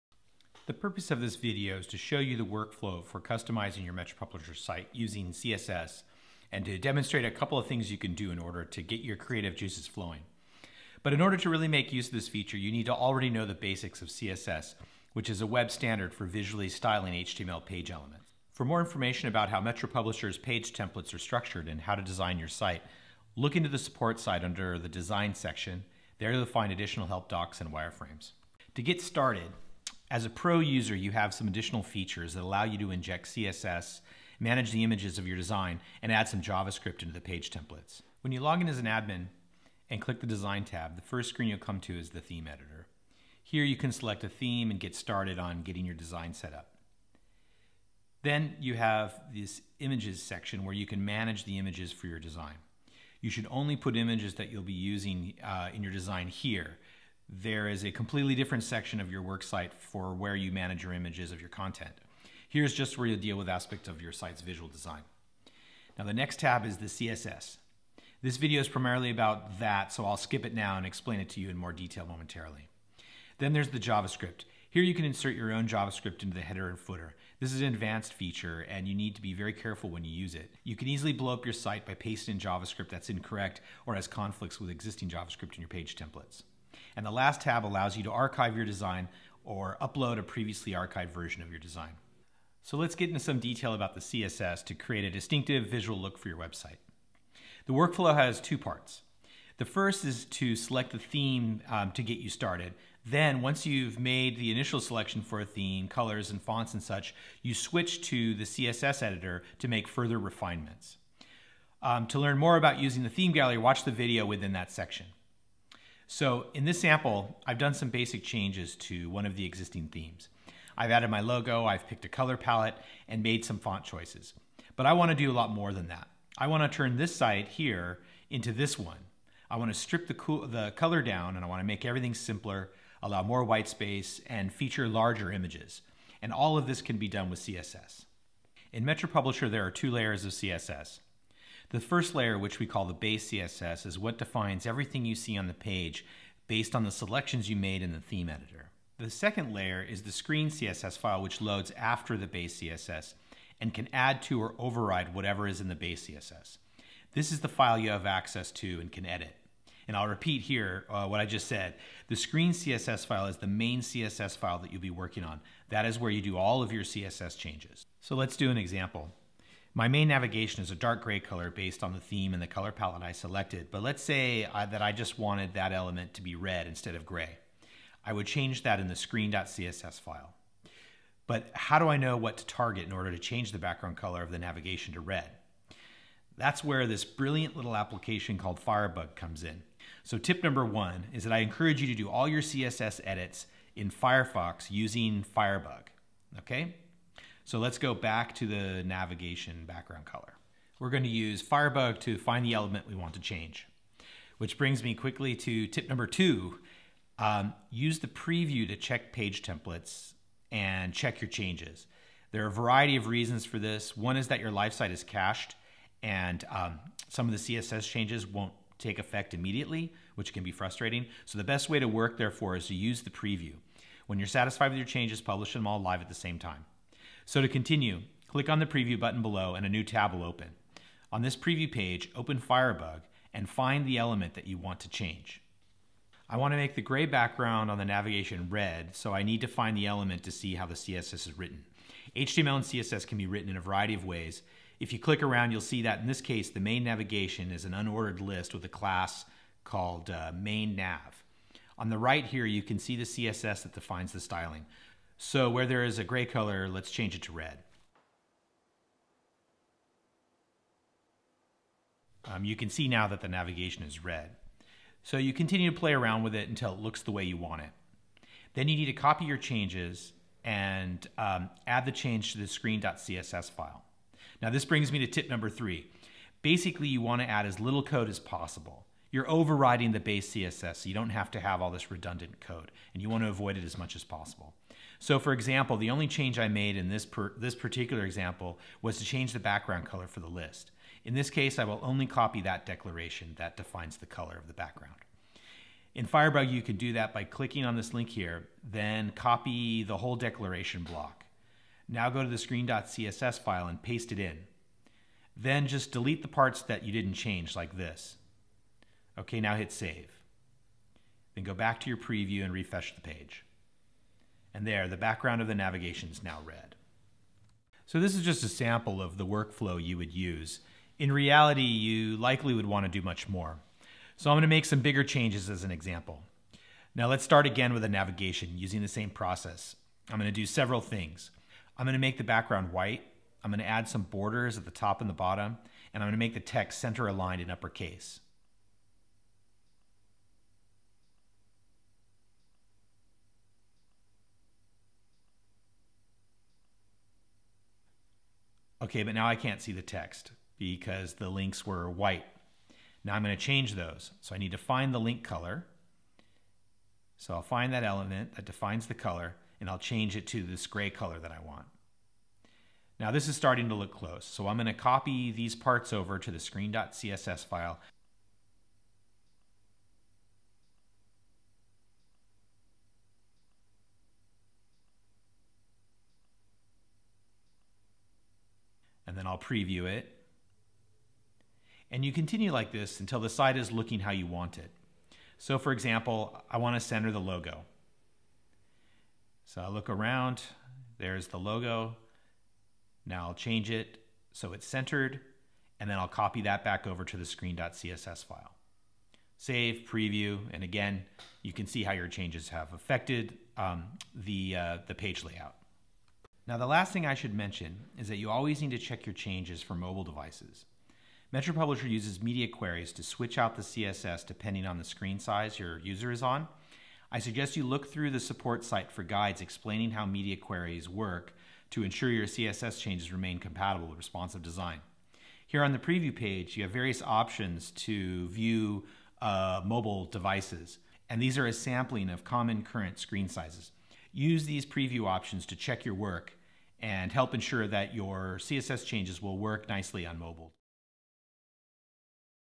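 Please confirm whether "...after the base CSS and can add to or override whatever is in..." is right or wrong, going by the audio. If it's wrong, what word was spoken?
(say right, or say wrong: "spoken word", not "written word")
right.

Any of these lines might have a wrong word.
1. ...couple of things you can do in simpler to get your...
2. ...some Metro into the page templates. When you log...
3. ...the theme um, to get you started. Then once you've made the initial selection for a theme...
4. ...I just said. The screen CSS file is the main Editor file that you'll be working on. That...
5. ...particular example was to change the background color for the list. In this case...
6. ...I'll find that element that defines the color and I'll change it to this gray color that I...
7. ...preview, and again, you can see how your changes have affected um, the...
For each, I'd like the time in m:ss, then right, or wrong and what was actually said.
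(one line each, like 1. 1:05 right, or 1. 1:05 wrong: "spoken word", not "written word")
1. 0:07 wrong: "order", not "simpler"
2. 0:36 wrong: "JavaScript", not "Metro"
3. 1:40 right
4. 2:41 wrong: "CSS", not "Editor"
5. 4:47 right
6. 5:57 right
7. 6:39 right.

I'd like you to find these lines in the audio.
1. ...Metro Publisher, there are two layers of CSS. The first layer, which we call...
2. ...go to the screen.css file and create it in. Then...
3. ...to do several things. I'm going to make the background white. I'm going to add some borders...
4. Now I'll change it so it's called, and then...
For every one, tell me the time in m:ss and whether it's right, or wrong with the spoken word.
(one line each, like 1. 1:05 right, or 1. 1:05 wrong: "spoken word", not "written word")
1. 2:18 right
2. 5:02 wrong: "paste", not "create"
3. 5:30 right
4. 6:33 wrong: "centered", not "called".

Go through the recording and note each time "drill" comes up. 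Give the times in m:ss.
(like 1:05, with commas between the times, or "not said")
not said.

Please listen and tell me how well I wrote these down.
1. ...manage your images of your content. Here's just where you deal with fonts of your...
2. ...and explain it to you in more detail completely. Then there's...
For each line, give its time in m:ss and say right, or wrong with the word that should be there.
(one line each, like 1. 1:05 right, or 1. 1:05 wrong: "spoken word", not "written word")
1. 1:00 wrong: "aspects", not "fonts"
2. 1:10 wrong: "momentarily", not "completely".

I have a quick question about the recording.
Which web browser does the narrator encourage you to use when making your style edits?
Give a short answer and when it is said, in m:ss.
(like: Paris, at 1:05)
Firefox, at 3:13.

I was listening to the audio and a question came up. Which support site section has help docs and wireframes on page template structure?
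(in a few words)
Design section.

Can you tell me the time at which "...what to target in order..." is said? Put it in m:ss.
3:02.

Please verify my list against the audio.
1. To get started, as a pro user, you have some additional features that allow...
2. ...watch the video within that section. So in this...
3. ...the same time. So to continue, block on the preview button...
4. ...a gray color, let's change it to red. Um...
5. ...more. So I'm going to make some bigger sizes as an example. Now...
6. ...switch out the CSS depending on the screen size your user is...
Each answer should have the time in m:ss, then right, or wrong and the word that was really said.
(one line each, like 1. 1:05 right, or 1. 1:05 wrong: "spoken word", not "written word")
1. 0:28 right
2. 1:53 right
3. 3:46 wrong: "click", not "block"
4. 4:15 right
5. 5:23 wrong: "changes", not "sizes"
6. 6:53 right.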